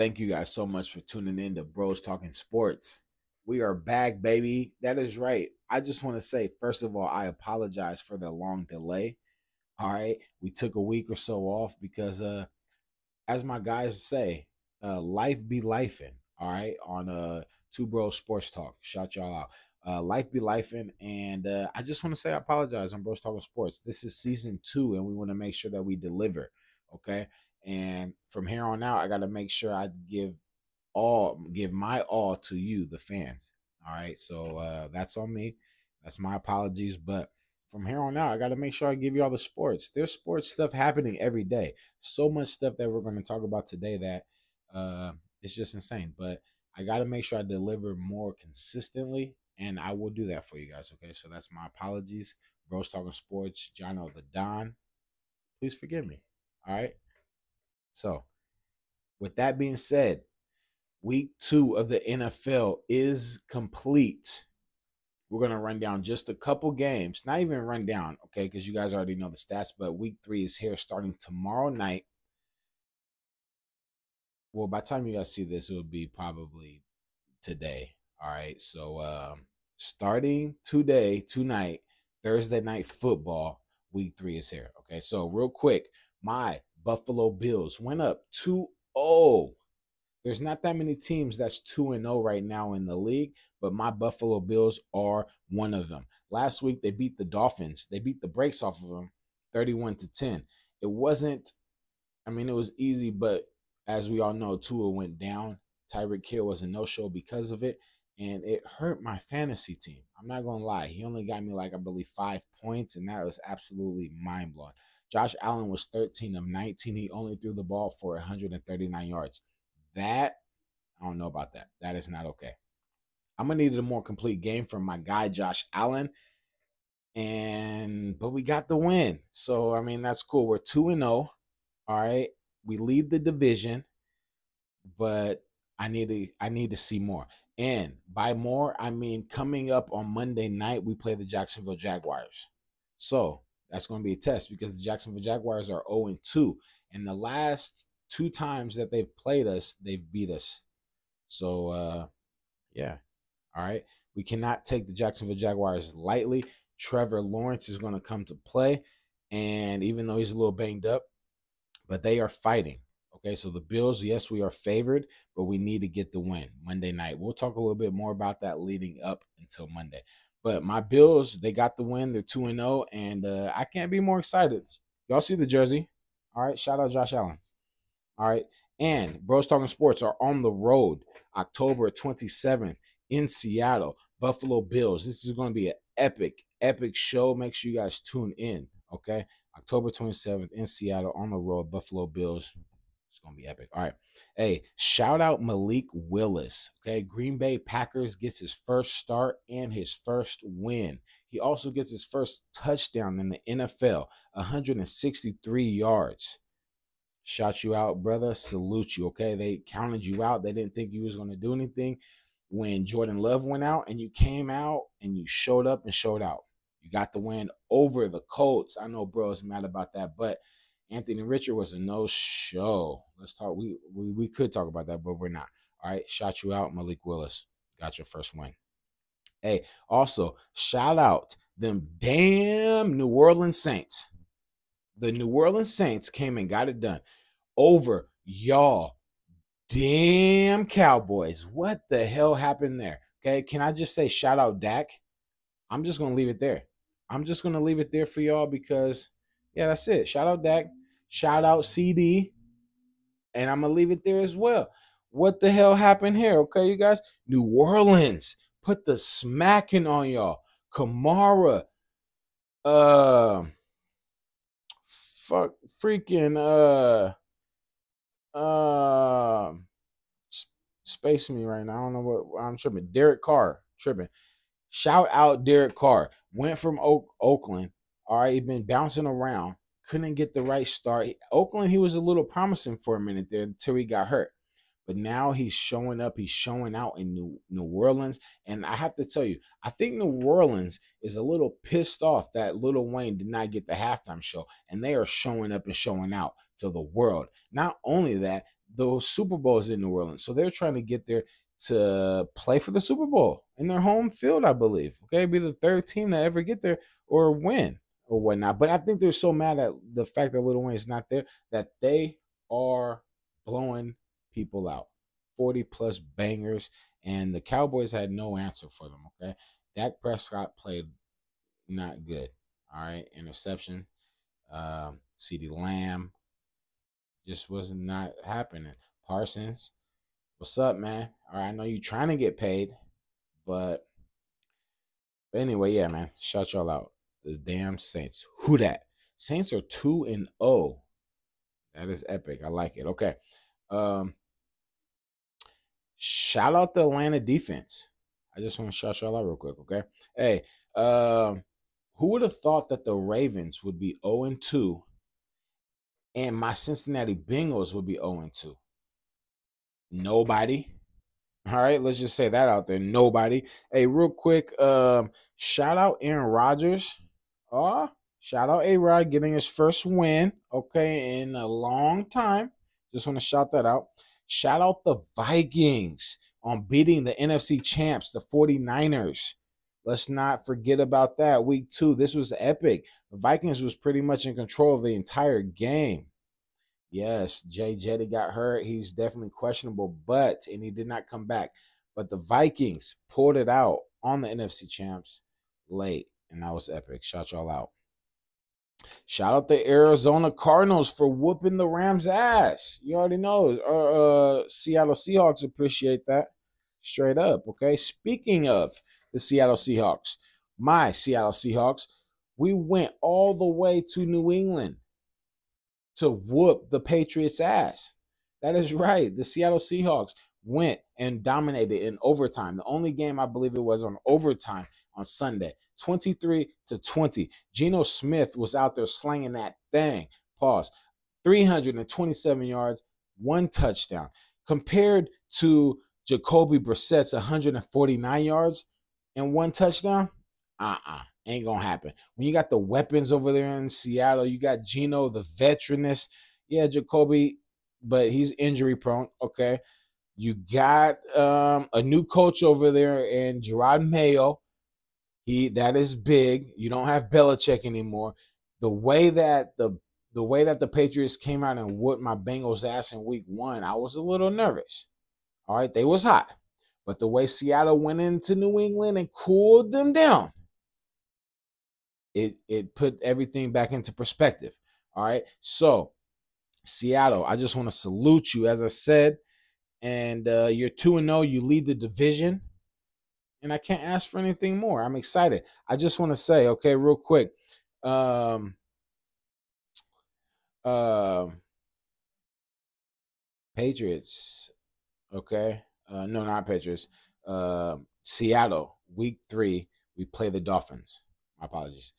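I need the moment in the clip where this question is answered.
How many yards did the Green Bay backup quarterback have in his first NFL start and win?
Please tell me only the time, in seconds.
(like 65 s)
204 s.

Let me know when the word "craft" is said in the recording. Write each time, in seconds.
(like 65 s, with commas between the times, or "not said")
not said.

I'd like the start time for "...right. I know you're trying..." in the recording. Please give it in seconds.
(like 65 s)
331 s.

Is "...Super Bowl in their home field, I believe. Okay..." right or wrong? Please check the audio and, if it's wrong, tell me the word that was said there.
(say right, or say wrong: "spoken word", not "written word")
right.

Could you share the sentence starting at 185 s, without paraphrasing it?
This is going to be an epic, epic show.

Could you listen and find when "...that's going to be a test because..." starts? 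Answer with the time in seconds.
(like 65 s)
143 s.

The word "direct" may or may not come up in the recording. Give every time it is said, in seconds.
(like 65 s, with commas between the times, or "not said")
not said.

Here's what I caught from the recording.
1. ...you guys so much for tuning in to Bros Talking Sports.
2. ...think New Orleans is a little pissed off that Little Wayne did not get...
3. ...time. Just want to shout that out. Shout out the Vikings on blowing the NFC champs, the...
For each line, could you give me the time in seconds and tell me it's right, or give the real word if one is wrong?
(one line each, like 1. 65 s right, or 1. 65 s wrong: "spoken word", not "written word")
1. 0 s right
2. 289 s right
3. 372 s wrong: "beating", not "blowing".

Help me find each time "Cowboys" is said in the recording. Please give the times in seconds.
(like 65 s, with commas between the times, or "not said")
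240 s, 317 s.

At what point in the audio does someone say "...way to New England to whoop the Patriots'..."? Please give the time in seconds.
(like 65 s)
413 s.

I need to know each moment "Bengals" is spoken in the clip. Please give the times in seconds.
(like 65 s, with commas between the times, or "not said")
357 s, 462 s.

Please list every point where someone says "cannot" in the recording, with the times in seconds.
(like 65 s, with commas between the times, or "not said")
154 s.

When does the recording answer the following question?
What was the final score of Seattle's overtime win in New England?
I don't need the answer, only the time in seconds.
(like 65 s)
425 s.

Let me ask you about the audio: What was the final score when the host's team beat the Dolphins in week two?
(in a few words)
31 to 10.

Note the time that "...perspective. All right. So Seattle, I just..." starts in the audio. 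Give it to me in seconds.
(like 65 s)
473 s.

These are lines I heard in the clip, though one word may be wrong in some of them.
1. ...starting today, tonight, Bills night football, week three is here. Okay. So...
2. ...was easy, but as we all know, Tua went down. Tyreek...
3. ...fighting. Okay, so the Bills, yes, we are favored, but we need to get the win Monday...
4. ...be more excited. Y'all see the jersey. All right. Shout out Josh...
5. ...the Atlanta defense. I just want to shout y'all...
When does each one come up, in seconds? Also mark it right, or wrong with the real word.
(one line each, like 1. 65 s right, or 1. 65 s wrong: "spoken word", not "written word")
1. 79 s wrong: "Thursday", not "Bills"
2. 102 s right
3. 162 s right
4. 173 s right
5. 346 s right.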